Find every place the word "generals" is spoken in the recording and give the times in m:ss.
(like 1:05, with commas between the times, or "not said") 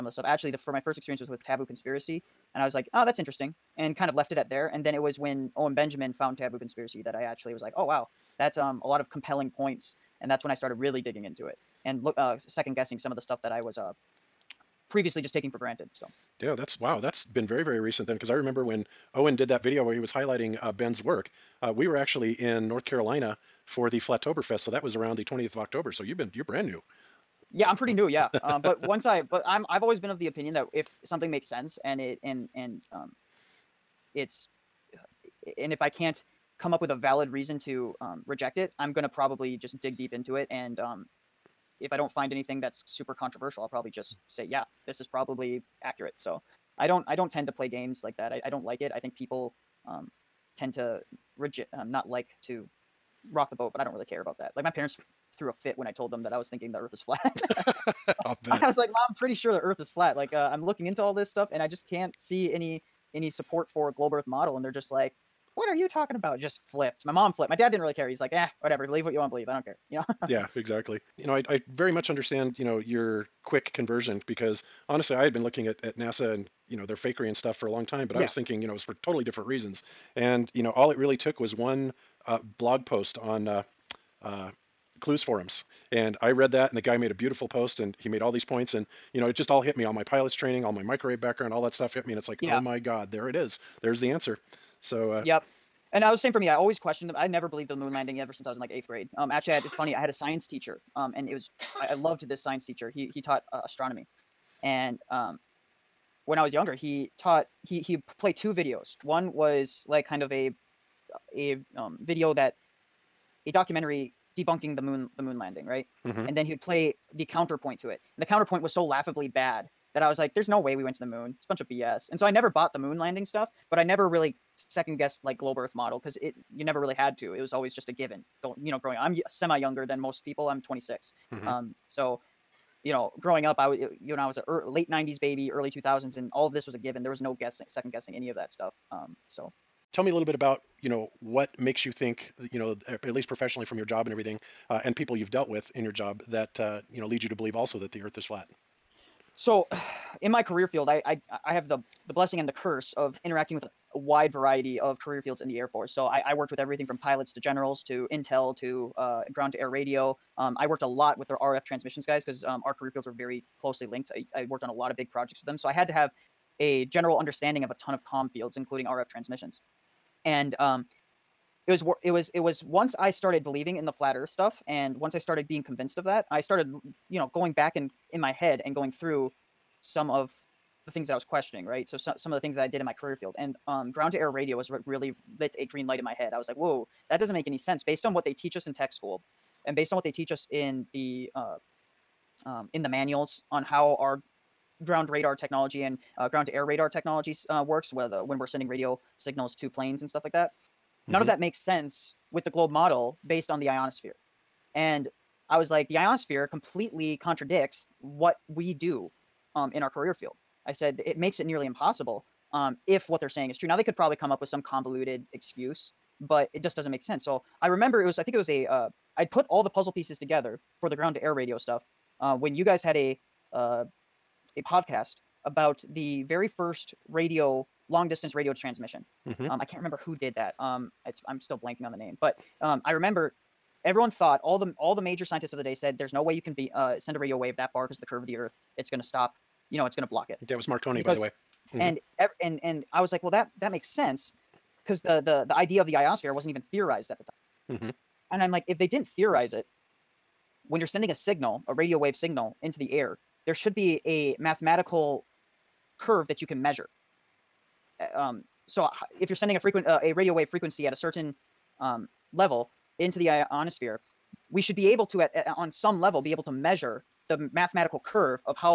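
2:37, 2:46.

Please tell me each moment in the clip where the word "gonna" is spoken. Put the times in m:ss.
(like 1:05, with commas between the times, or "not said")
0:38.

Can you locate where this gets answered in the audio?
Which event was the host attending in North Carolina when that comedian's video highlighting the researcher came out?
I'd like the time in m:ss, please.
0:23.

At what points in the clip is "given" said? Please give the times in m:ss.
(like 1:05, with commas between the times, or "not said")
2:07, 2:16.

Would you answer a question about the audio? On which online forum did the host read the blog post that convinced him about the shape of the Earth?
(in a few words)
Clues forums.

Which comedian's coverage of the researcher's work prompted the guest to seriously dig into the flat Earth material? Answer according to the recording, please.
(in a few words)
Owen Benjamin.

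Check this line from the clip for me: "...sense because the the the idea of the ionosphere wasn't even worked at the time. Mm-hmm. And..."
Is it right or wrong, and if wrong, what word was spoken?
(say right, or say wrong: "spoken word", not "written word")
wrong: "theorized", not "worked".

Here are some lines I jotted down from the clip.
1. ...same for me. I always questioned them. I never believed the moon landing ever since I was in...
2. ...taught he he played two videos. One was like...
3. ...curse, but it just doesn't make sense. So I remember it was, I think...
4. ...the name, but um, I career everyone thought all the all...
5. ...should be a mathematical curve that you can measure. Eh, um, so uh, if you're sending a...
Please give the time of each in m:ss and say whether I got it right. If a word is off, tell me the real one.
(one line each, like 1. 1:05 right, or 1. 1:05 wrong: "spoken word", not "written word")
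1. 1:36 right
2. 1:47 right
3. 3:35 wrong: "excuse", not "curse"
4. 3:51 wrong: "remember", not "career"
5. 4:13 right.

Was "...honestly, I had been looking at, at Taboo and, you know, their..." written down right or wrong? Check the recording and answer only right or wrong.
wrong.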